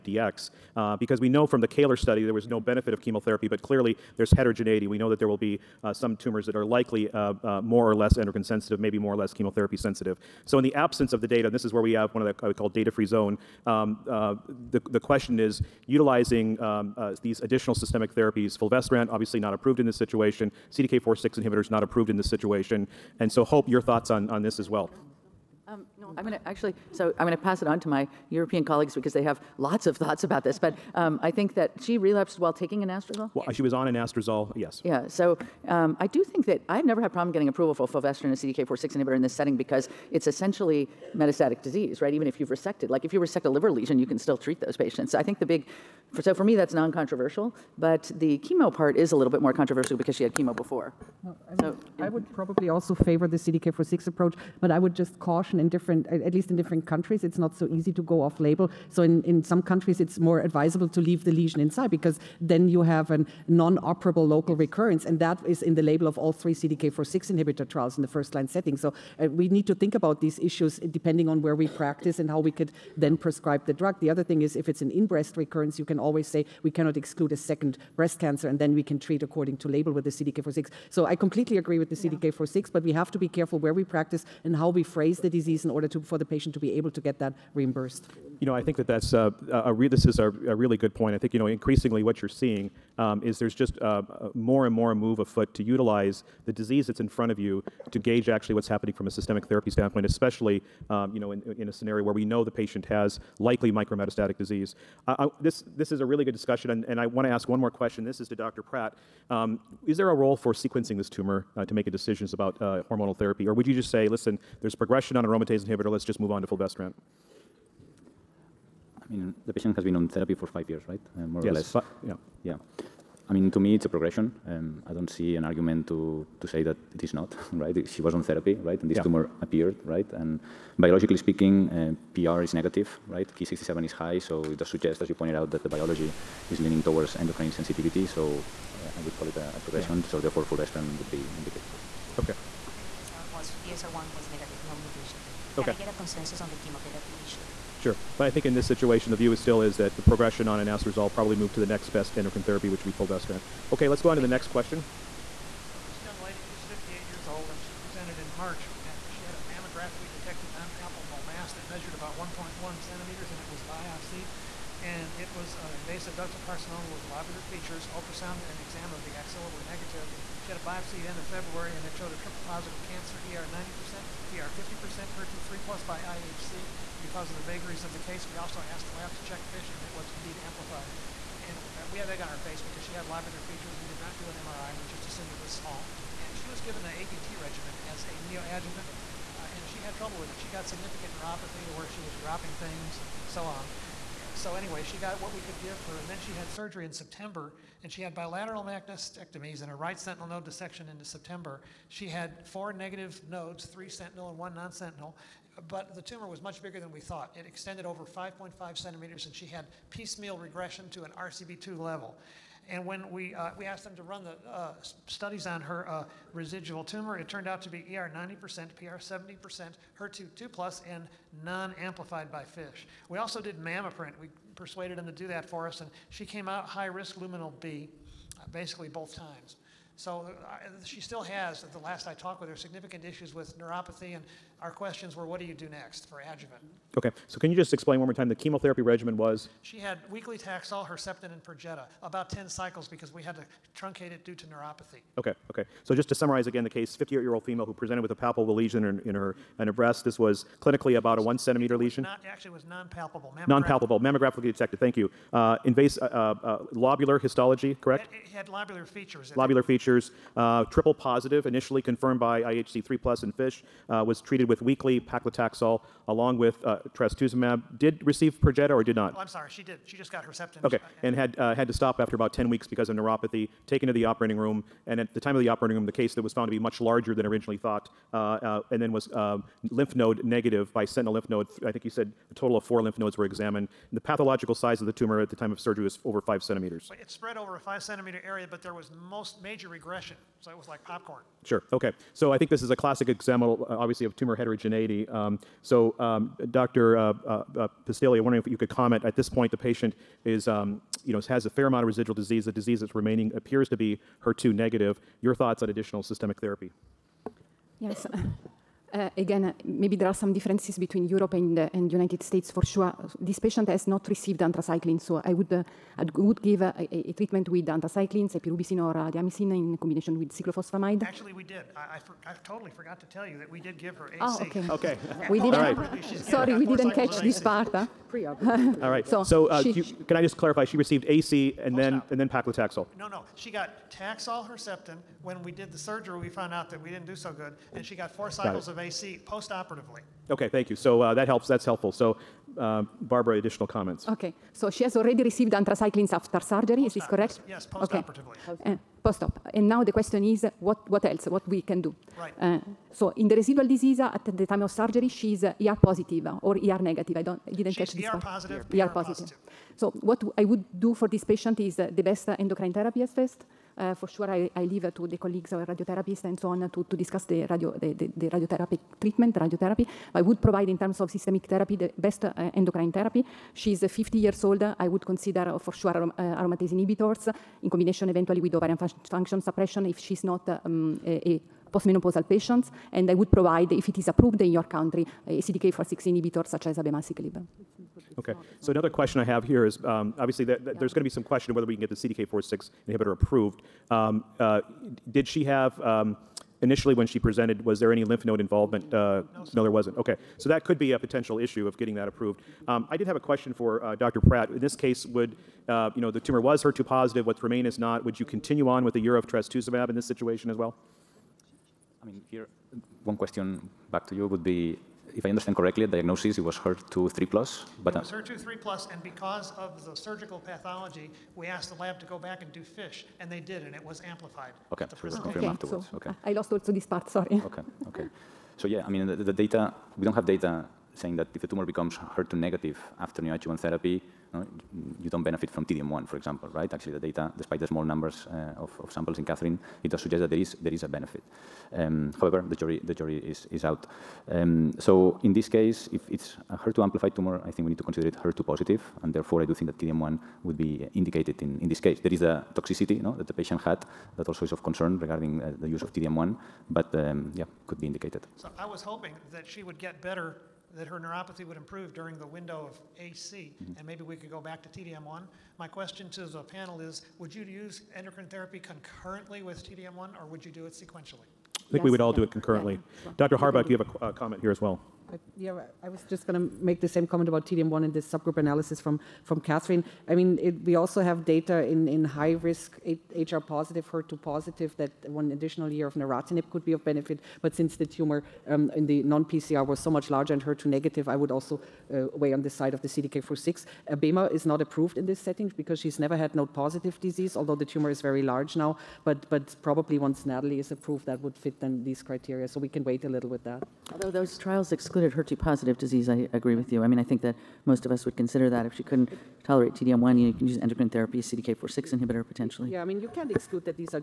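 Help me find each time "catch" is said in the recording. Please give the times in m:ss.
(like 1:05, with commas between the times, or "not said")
5:26, 5:57.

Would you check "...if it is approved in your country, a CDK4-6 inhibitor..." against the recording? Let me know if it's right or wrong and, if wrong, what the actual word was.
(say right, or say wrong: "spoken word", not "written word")
right.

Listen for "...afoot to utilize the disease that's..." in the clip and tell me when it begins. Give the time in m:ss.
1:35.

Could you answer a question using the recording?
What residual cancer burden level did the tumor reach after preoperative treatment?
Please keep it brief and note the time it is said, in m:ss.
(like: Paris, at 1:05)
RCB2, at 3:31.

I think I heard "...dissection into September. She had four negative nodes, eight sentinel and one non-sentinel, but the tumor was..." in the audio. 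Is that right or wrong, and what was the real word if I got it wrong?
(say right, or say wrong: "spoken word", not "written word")
wrong: "three", not "eight".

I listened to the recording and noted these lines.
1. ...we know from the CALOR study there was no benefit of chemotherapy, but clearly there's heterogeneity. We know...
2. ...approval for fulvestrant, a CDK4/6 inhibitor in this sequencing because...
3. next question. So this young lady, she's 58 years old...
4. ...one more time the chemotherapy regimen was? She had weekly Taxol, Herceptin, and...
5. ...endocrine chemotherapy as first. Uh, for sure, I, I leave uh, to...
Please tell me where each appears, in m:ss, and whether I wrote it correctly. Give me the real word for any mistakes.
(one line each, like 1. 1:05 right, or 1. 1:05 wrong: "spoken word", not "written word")
1. 0:01 right
2. 0:37 wrong: "setting", not "sequencing"
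3. 2:34 right
4. 3:57 right
5. 6:02 wrong: "therapy", not "chemotherapy".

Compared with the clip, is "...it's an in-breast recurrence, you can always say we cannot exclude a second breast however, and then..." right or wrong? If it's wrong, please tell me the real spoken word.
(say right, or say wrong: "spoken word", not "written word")
wrong: "cancer", not "however".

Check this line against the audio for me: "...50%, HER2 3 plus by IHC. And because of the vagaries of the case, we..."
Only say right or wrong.
right.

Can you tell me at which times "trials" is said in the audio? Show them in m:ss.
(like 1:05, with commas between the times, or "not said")
1:07, 8:24.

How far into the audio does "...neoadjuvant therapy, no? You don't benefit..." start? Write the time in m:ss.
7:13.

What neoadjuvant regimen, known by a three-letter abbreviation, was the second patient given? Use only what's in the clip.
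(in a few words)
APT.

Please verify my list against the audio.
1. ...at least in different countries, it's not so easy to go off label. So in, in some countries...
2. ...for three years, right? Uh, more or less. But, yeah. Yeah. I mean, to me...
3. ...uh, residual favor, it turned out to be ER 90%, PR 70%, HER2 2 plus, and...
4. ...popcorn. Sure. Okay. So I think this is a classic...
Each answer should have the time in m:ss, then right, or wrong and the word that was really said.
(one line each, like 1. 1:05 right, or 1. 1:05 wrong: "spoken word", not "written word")
1. 0:56 right
2. 2:00 wrong: "five", not "three"
3. 3:35 wrong: "tumor", not "favor"
4. 4:50 right.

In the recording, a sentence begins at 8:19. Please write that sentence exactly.
But, but probably once NATALEE is approved, that would fit then these criteria.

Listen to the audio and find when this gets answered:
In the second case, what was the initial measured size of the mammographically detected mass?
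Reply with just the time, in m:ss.
2:42.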